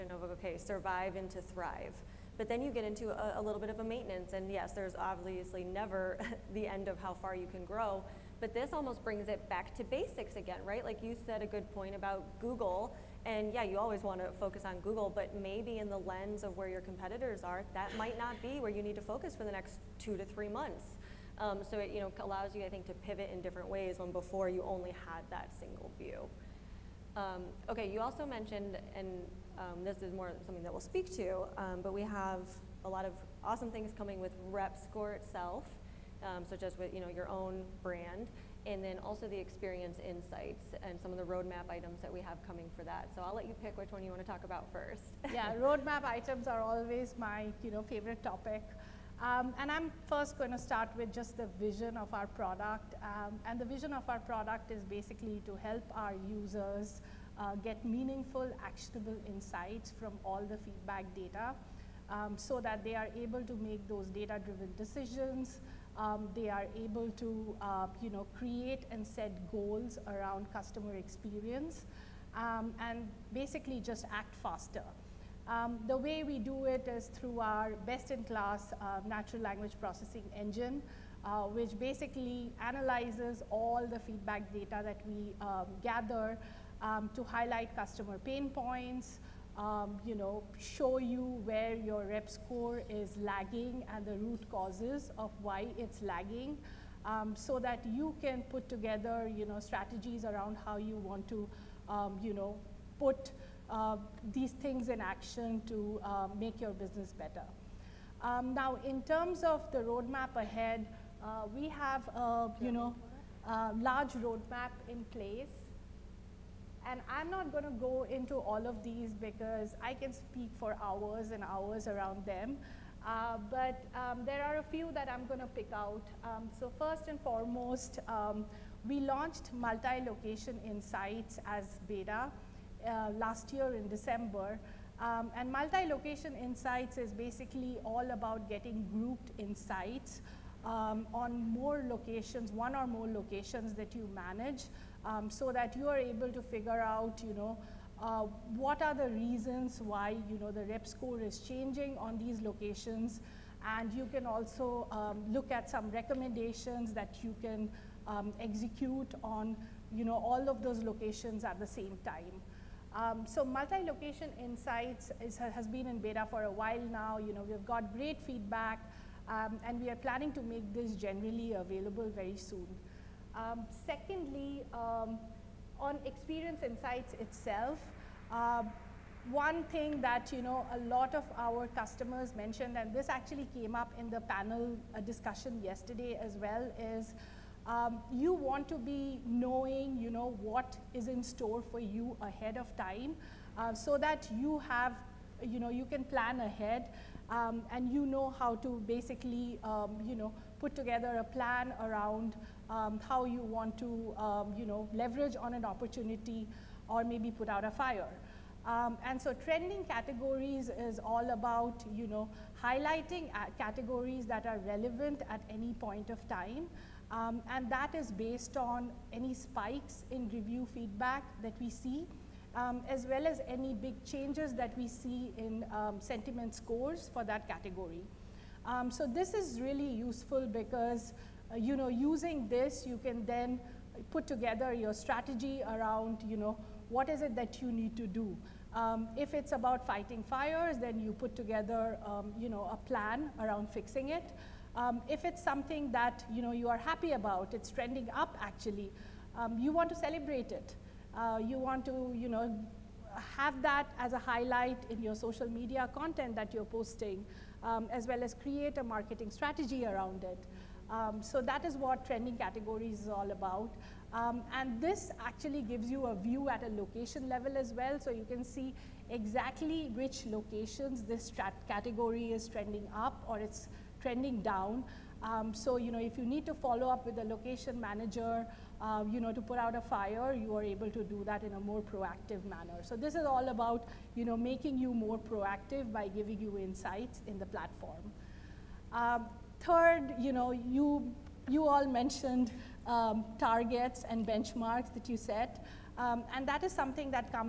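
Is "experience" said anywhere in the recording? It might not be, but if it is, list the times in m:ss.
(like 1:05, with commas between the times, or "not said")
0:39, 1:10, 2:56.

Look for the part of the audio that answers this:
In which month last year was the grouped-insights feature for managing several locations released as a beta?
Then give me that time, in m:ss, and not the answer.
2:13.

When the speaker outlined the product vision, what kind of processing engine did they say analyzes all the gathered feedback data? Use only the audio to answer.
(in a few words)
natural language processing.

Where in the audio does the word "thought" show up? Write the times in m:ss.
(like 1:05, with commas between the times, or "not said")
not said.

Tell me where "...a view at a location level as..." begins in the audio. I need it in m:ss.
4:26.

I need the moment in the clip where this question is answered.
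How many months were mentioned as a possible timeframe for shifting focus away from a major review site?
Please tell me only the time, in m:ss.
0:19.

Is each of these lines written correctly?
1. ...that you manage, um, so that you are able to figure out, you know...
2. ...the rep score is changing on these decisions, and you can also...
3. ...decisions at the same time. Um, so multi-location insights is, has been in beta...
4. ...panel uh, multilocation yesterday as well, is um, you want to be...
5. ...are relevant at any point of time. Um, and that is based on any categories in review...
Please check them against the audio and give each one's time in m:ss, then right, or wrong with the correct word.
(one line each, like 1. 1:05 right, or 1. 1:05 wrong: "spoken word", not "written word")
1. 2:23 right
2. 2:30 wrong: "locations", not "decisions"
3. 2:40 wrong: "locations", not "decisions"
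4. 3:04 wrong: "discussion", not "multilocation"
5. 3:34 wrong: "spikes", not "categories".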